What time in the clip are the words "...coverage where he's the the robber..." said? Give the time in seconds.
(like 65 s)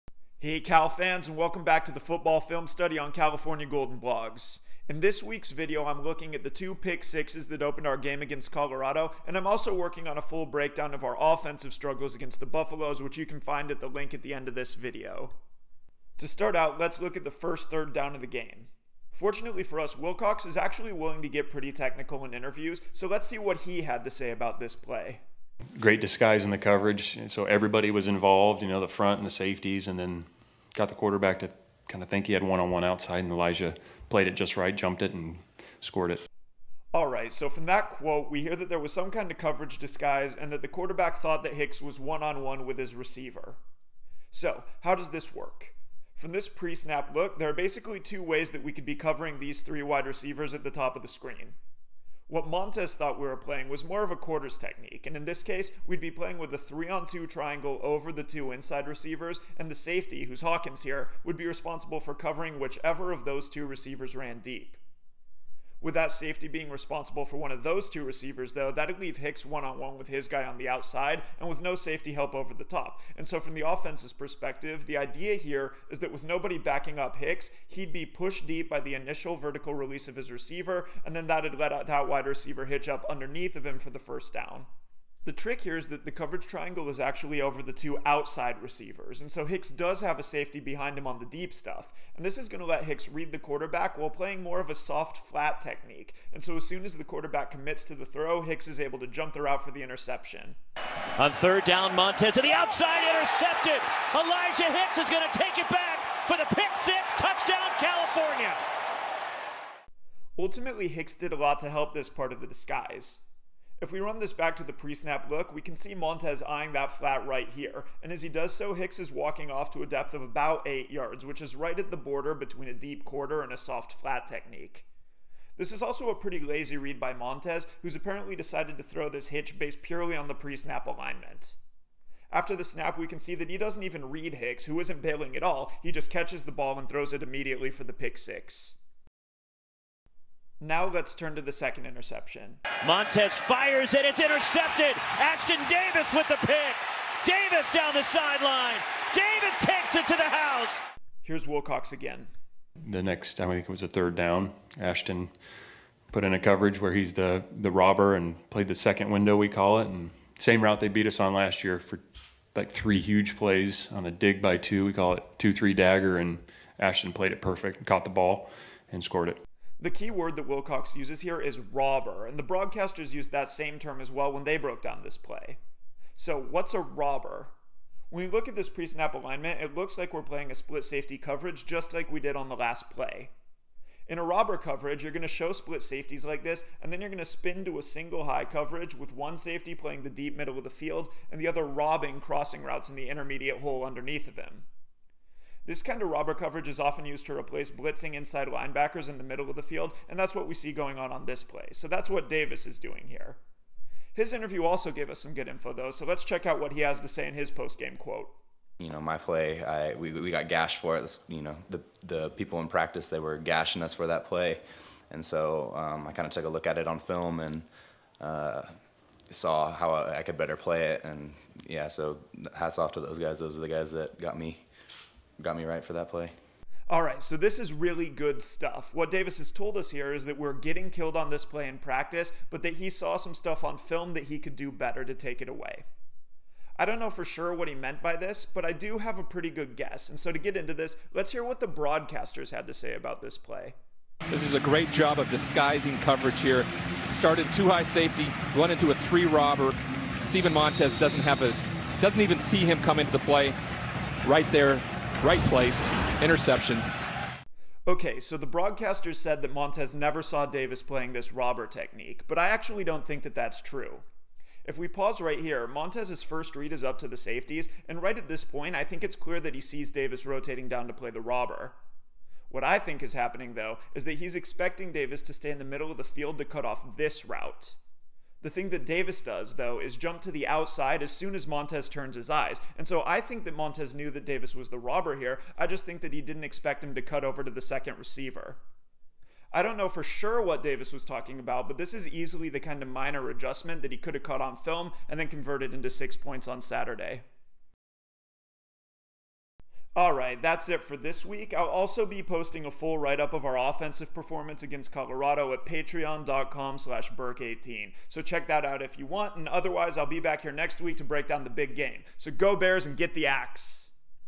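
156 s.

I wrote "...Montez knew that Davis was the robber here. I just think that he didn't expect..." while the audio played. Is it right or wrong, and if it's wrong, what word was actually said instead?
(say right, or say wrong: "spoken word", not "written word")
right.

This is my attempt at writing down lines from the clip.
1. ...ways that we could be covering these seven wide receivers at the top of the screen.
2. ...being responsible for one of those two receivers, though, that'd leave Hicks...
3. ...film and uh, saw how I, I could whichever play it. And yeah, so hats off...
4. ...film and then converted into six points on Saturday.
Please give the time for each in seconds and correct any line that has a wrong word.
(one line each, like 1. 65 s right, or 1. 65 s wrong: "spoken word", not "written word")
1. 48 s wrong: "three", not "seven"
2. 66 s right
3. 216 s wrong: "better", not "whichever"
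4. 294 s right.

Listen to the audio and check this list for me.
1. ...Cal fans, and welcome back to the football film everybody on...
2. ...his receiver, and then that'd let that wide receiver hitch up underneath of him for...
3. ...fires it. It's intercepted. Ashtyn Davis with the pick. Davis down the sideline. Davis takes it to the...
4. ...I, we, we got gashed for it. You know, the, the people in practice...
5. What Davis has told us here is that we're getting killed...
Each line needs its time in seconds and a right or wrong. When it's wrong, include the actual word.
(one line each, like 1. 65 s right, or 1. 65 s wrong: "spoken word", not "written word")
1. 0 s wrong: "study", not "everybody"
2. 80 s right
3. 143 s right
4. 209 s right
5. 228 s right.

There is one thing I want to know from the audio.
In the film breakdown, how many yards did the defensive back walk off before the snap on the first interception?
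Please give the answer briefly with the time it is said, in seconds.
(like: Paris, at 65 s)
8, at 120 s.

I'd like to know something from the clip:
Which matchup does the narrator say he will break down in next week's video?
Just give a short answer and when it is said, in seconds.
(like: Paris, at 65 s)
the big game, at 311 s.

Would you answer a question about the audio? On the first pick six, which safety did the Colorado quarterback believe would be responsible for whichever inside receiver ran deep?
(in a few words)
Hawkins.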